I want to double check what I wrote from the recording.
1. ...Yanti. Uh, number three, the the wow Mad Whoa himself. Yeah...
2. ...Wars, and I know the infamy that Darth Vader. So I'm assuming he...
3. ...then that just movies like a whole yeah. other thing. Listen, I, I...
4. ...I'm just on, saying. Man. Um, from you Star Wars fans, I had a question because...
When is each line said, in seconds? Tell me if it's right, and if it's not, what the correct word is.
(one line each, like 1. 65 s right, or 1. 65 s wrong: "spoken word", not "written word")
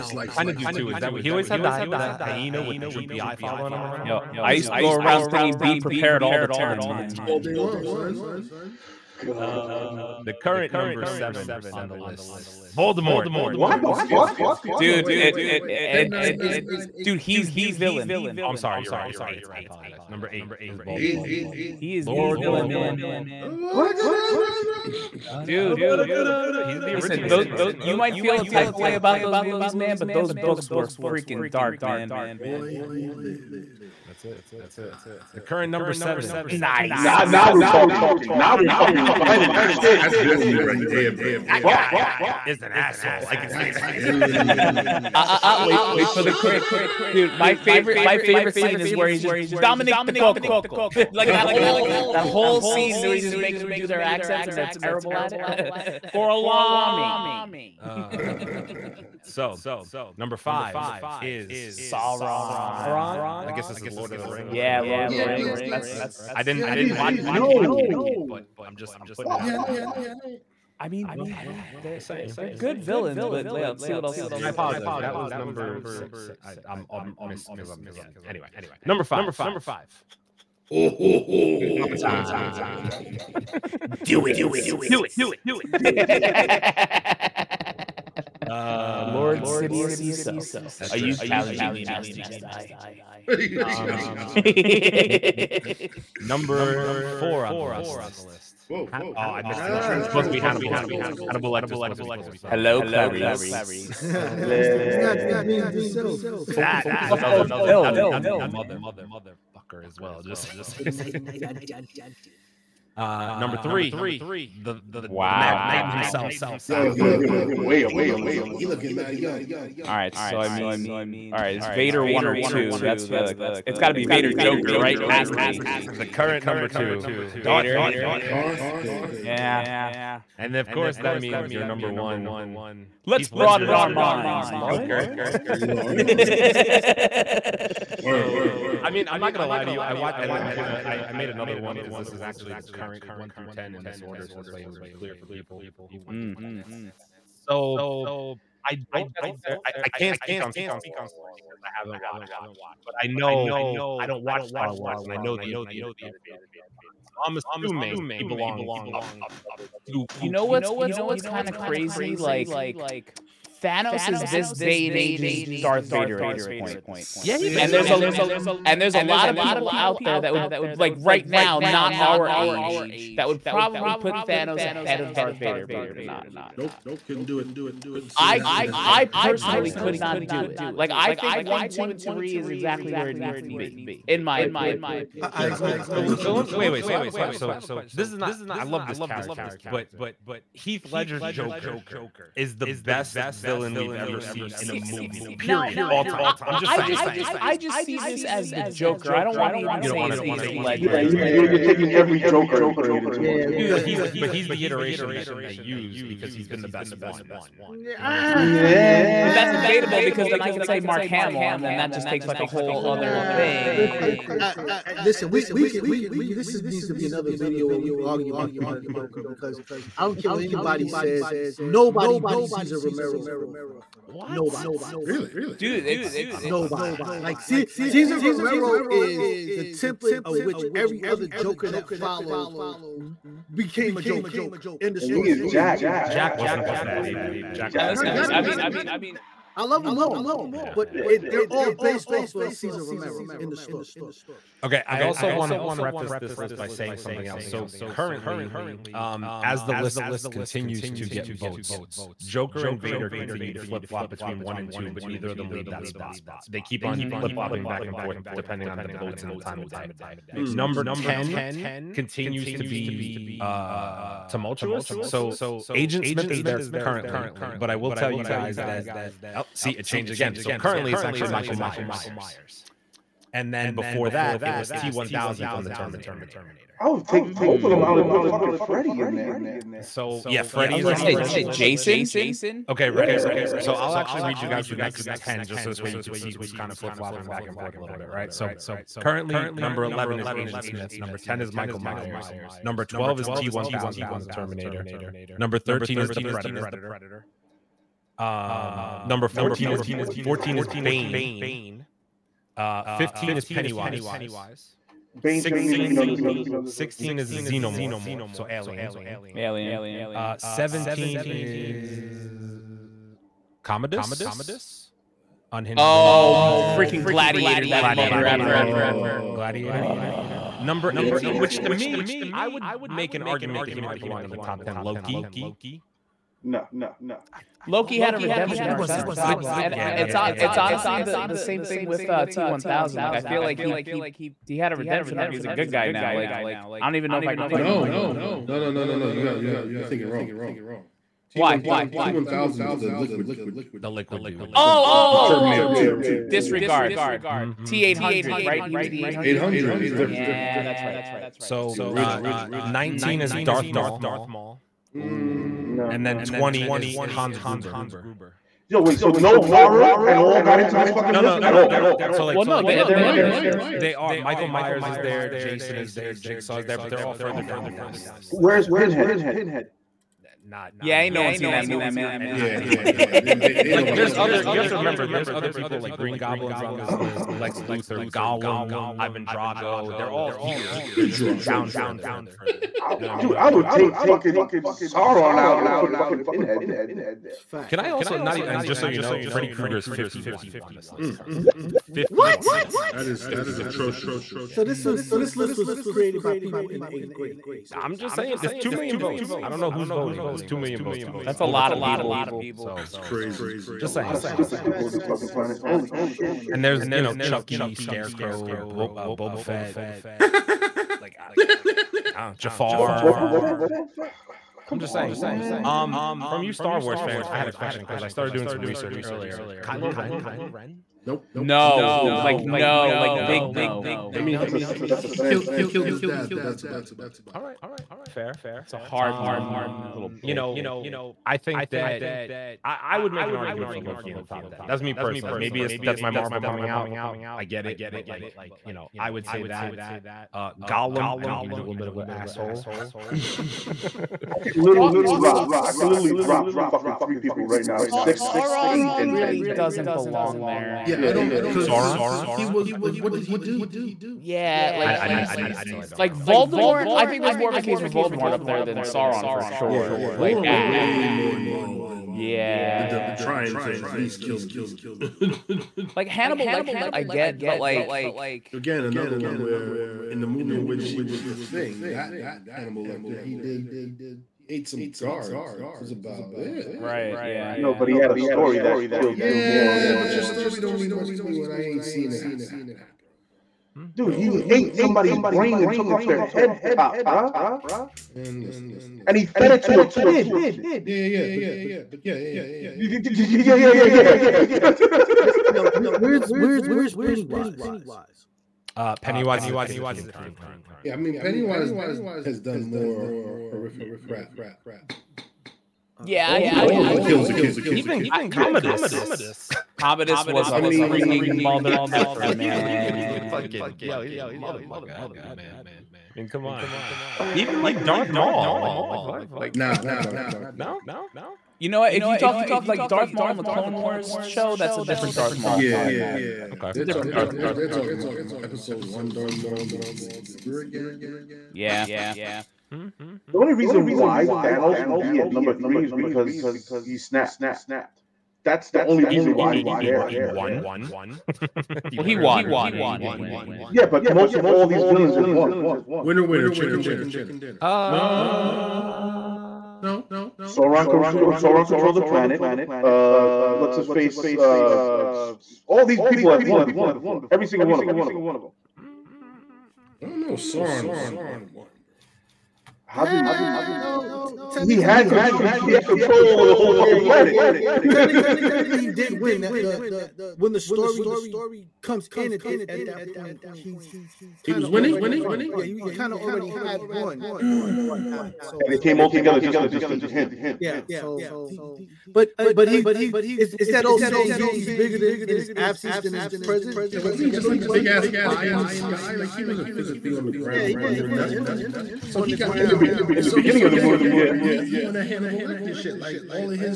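1. 111 s wrong: "Titan", not "Whoa"
2. 154 s right
3. 211 s wrong: "takes", not "movies"
4. 414 s right.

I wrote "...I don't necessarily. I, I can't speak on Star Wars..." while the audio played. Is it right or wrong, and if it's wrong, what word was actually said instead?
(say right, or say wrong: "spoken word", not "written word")
right.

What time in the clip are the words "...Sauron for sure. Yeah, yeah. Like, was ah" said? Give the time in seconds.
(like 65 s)
458 s.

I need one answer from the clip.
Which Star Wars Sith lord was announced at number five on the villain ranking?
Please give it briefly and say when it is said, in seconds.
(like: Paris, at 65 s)
Lord Sidious, at 89 s.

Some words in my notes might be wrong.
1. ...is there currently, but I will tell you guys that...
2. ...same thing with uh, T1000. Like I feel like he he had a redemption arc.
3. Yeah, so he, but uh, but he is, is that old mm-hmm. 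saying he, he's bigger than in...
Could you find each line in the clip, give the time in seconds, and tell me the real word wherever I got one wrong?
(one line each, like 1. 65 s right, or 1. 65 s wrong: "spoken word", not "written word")
1. 266 s right
2. 331 s right
3. 580 s right.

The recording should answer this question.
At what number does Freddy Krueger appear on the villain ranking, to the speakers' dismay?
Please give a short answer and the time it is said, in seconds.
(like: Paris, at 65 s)
51, at 389 s.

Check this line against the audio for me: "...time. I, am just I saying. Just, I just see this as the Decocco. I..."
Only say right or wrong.
wrong.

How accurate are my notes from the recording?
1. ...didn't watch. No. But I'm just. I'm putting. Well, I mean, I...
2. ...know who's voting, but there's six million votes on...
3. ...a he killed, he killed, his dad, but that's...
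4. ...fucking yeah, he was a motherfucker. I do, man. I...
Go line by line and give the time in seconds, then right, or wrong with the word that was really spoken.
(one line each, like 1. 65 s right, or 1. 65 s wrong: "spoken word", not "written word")
1. 66 s right
2. 399 s wrong: "two", not "six"
3. 425 s right
4. 513 s right.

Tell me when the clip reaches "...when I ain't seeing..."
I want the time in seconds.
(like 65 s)
481 s.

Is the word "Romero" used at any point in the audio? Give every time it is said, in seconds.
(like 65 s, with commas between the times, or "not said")
222 s, 228 s, 242 s.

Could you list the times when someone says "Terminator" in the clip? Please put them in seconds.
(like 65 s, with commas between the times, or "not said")
275 s, 294 s, 345 s.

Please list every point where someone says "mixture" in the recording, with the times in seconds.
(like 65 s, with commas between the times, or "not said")
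not said.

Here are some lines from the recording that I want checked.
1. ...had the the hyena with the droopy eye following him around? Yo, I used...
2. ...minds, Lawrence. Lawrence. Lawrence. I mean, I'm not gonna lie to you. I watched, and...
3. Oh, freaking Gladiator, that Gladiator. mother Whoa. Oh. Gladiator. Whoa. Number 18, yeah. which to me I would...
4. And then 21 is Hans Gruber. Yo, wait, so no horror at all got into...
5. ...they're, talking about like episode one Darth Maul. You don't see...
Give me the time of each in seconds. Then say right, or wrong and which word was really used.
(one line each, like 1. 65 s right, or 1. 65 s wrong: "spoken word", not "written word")
1. 1 s right
2. 133 s right
3. 315 s right
4. 355 s wrong: "20", not "21"
5. 527 s right.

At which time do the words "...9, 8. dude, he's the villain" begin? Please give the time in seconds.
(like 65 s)
16 s.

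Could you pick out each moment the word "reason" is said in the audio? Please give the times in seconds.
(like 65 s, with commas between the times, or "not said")
533 s, 539 s.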